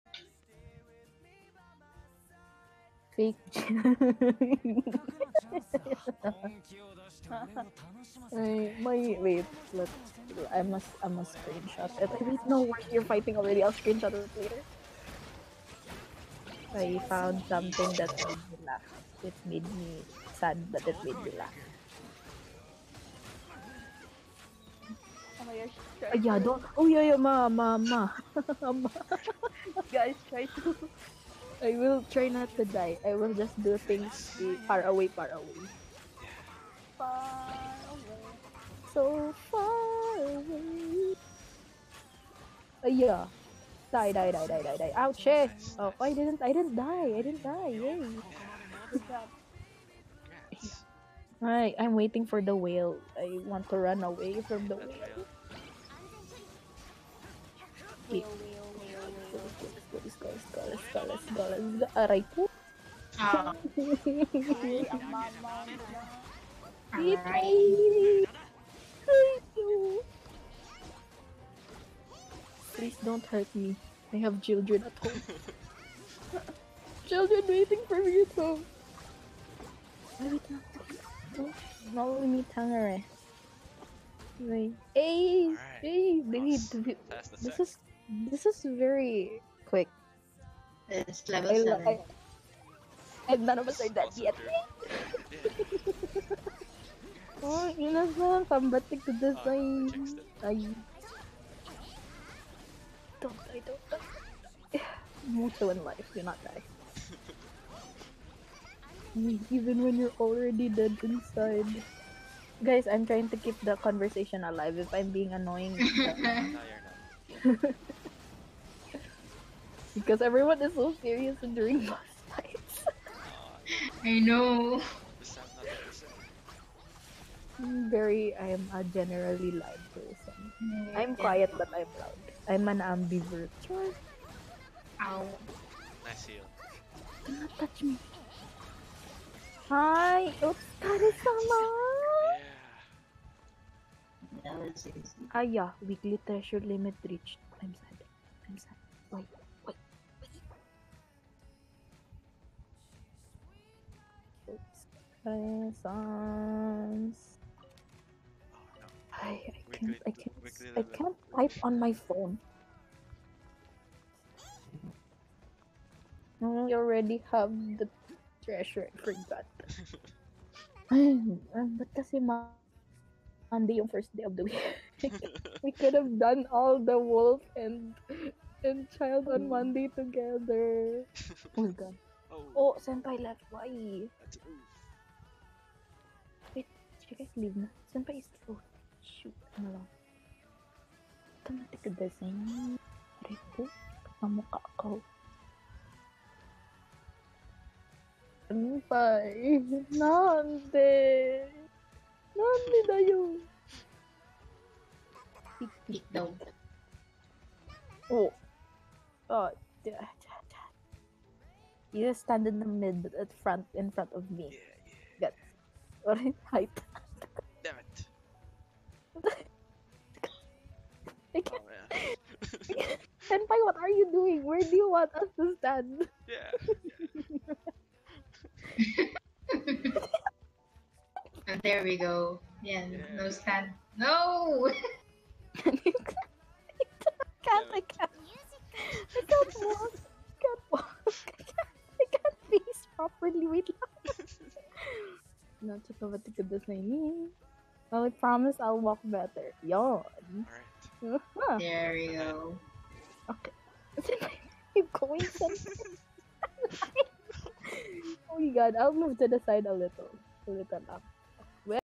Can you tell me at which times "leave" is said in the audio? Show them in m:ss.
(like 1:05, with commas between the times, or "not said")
3:07.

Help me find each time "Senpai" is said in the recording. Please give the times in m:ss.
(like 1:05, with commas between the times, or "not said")
3:02, 3:07, 3:18, 3:43.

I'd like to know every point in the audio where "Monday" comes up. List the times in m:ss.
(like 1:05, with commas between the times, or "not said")
2:53, 2:59.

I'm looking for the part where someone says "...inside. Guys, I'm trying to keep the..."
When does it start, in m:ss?
1:51.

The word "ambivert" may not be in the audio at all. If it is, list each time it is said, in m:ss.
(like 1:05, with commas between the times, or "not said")
2:12.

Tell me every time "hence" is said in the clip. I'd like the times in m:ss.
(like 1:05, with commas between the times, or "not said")
not said.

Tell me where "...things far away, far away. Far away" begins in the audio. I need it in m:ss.
0:33.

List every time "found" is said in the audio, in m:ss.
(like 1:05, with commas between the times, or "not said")
0:17.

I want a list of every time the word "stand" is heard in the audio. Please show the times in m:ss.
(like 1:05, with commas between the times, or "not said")
3:32, 3:45, 3:53.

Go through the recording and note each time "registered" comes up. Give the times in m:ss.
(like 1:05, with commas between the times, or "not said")
not said.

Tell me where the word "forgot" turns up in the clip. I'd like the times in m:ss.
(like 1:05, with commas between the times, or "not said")
2:48.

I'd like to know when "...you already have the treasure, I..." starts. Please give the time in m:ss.
2:46.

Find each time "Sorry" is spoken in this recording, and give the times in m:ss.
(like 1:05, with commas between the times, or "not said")
3:36.